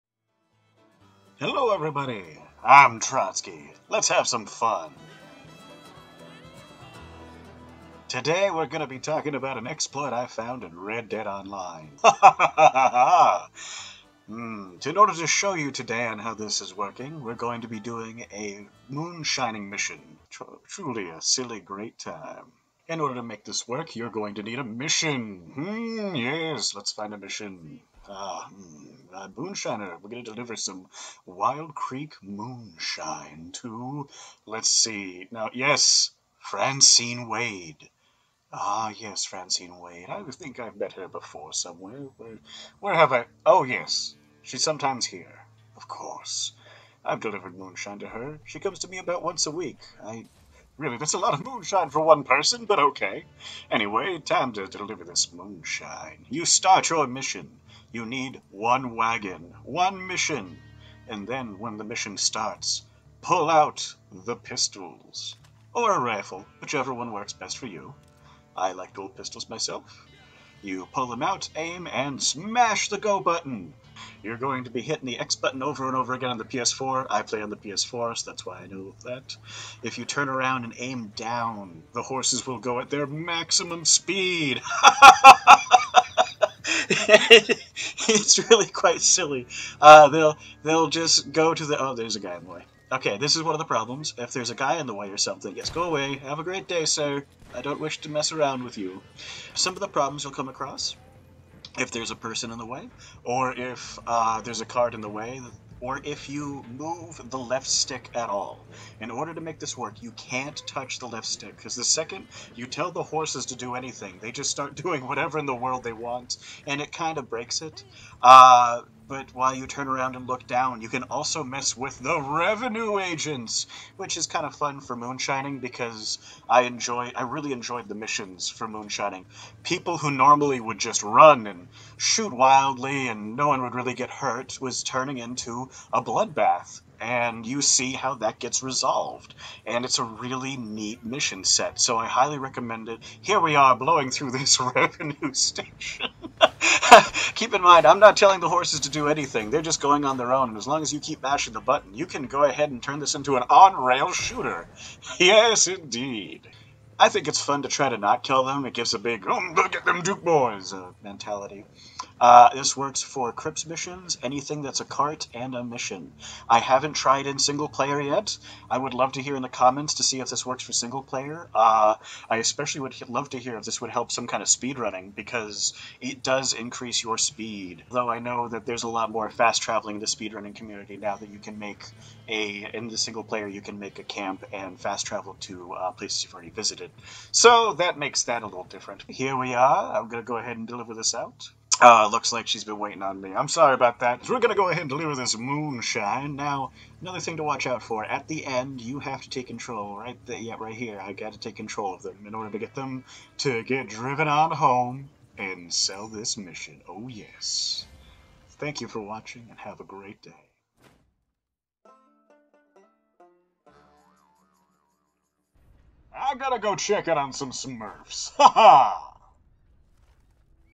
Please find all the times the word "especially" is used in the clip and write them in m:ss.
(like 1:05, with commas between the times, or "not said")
2:52.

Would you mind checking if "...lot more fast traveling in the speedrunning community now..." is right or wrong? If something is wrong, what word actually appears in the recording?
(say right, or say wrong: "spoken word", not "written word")
right.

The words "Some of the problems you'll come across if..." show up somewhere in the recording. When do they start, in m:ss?
1:39.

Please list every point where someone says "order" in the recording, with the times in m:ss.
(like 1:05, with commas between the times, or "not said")
0:14, 0:22, 1:49, 3:22.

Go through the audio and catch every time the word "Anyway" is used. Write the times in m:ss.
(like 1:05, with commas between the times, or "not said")
0:53.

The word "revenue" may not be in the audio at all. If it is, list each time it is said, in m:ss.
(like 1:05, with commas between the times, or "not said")
2:02, 2:24.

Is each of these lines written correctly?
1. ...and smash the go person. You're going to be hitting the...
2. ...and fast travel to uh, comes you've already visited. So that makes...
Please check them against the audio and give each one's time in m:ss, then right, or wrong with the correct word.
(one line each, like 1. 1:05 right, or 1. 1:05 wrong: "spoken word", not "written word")
1. 1:11 wrong: "button", not "person"
2. 3:04 wrong: "places", not "comes".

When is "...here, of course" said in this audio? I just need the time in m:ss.
0:45.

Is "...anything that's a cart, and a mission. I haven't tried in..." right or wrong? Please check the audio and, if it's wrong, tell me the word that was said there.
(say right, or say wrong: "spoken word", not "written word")
right.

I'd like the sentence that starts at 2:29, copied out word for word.
They're just going on their own.